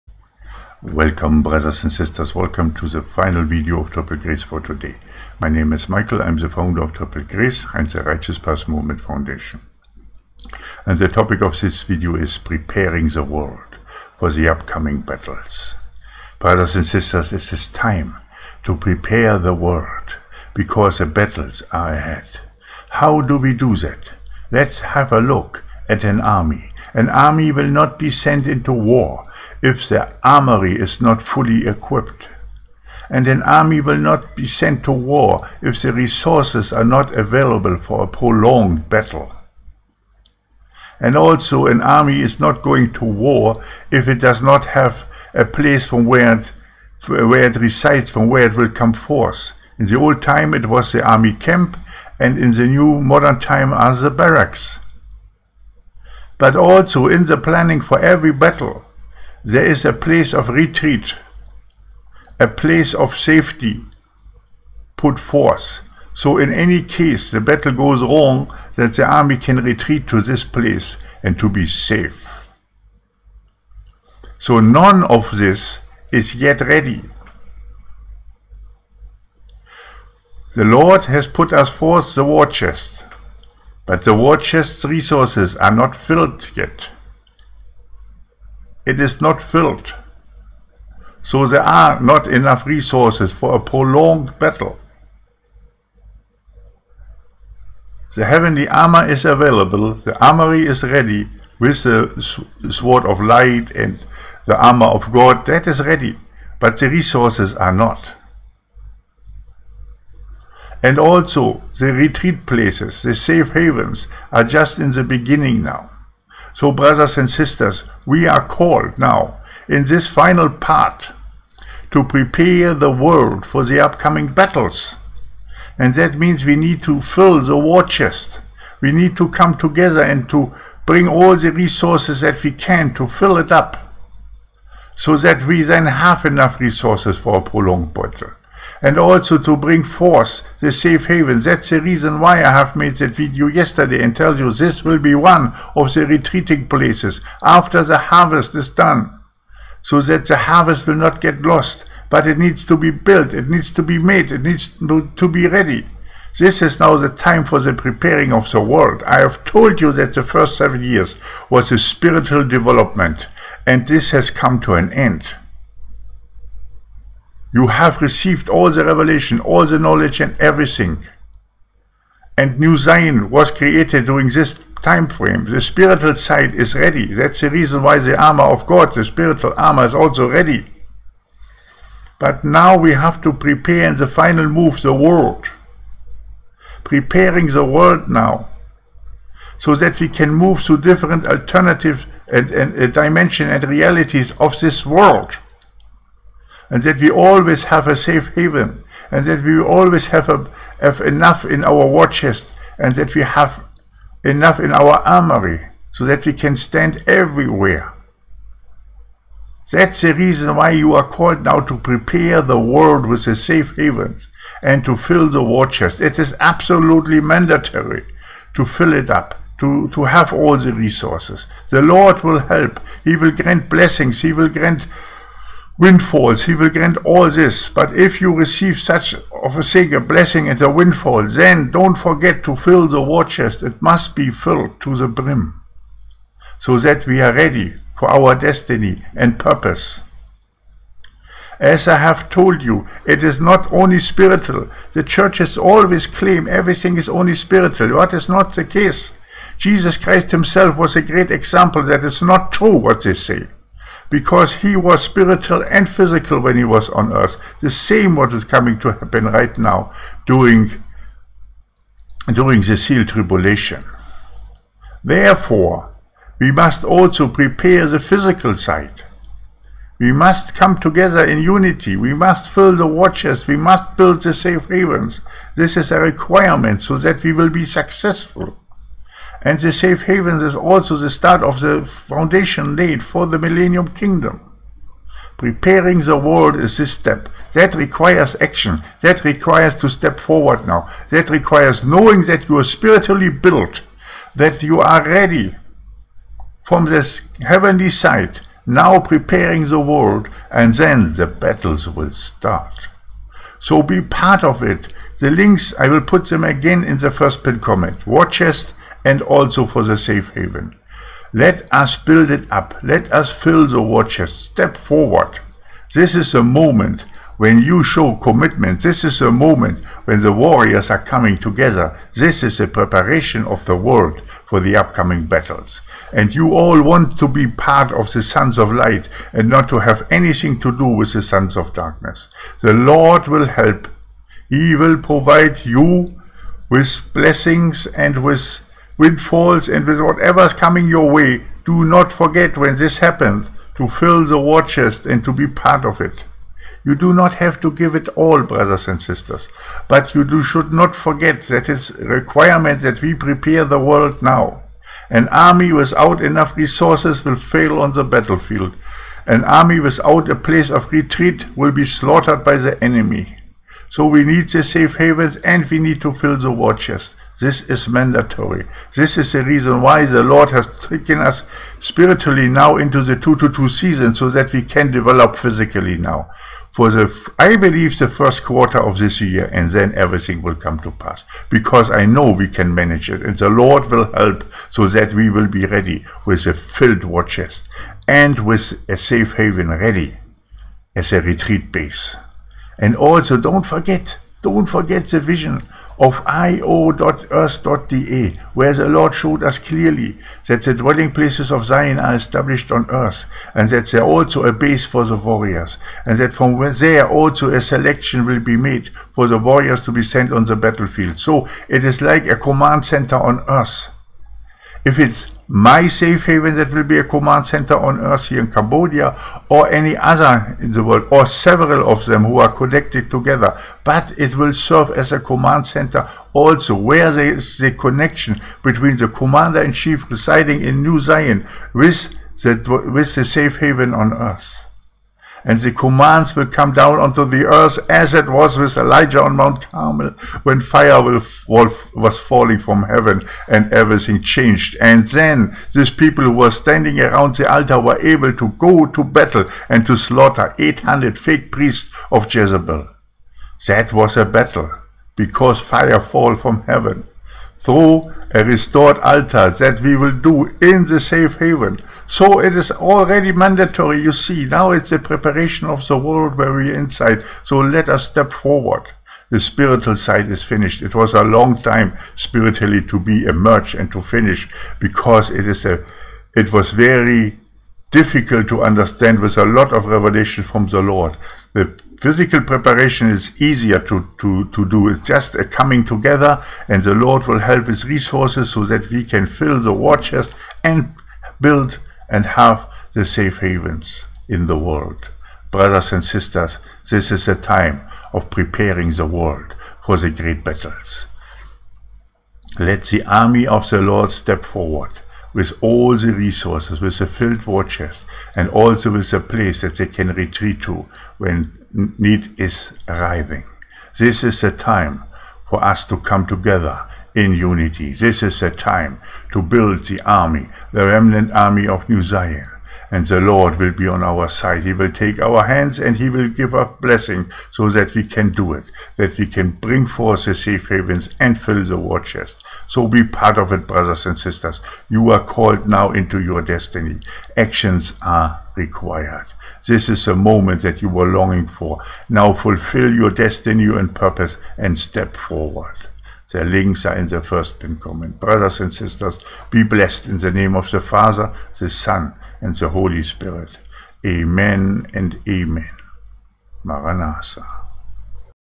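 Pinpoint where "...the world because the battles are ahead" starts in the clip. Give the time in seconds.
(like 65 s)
19 s.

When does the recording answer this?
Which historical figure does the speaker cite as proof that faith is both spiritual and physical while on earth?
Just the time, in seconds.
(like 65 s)
249 s.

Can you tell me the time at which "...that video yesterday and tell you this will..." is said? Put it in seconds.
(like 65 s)
142 s.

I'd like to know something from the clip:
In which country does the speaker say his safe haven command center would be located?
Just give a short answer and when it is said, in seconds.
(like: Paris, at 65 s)
Cambodia, at 418 s.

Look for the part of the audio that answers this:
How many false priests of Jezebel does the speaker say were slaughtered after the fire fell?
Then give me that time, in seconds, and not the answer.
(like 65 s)
450 s.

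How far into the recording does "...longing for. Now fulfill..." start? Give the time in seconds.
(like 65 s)
541 s.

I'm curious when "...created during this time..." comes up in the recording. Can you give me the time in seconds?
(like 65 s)
173 s.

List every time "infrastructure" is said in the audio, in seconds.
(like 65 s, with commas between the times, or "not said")
not said.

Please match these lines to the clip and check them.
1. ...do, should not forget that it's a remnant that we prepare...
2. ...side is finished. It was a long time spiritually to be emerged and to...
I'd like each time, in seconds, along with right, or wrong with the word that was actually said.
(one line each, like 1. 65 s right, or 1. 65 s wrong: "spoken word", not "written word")
1. 350 s wrong: "requirement", not "remnant"
2. 469 s right.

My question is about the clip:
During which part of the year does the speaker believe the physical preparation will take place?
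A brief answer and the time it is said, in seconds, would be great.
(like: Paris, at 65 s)
the first quarter, at 378 s.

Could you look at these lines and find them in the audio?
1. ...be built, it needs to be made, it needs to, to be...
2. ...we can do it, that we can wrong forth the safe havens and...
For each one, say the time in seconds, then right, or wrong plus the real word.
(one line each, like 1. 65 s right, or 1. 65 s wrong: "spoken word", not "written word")
1. 152 s right
2. 527 s wrong: "bring", not "wrong".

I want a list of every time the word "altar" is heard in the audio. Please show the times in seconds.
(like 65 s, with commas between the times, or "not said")
447 s, 458 s.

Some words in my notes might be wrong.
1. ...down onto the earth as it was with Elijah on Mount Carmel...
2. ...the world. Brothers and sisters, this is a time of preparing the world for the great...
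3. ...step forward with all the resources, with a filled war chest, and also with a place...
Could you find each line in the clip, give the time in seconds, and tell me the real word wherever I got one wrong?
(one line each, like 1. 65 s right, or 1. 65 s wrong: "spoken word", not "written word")
1. 436 s right
2. 494 s right
3. 504 s right.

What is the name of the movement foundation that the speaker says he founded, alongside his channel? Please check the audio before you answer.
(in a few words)
Righteous Path Movement Foundation.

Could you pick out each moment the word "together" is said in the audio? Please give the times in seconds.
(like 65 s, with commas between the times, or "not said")
129 s, 270 s, 321 s, 423 s, 485 s, 516 s.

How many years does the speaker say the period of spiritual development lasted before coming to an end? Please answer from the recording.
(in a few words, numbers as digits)
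7.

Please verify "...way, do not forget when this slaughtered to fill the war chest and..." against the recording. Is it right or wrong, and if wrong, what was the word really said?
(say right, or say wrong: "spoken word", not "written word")
wrong: "happened", not "slaughtered".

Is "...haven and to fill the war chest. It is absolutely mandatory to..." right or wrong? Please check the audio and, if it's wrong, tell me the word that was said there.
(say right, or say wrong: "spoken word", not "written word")
right.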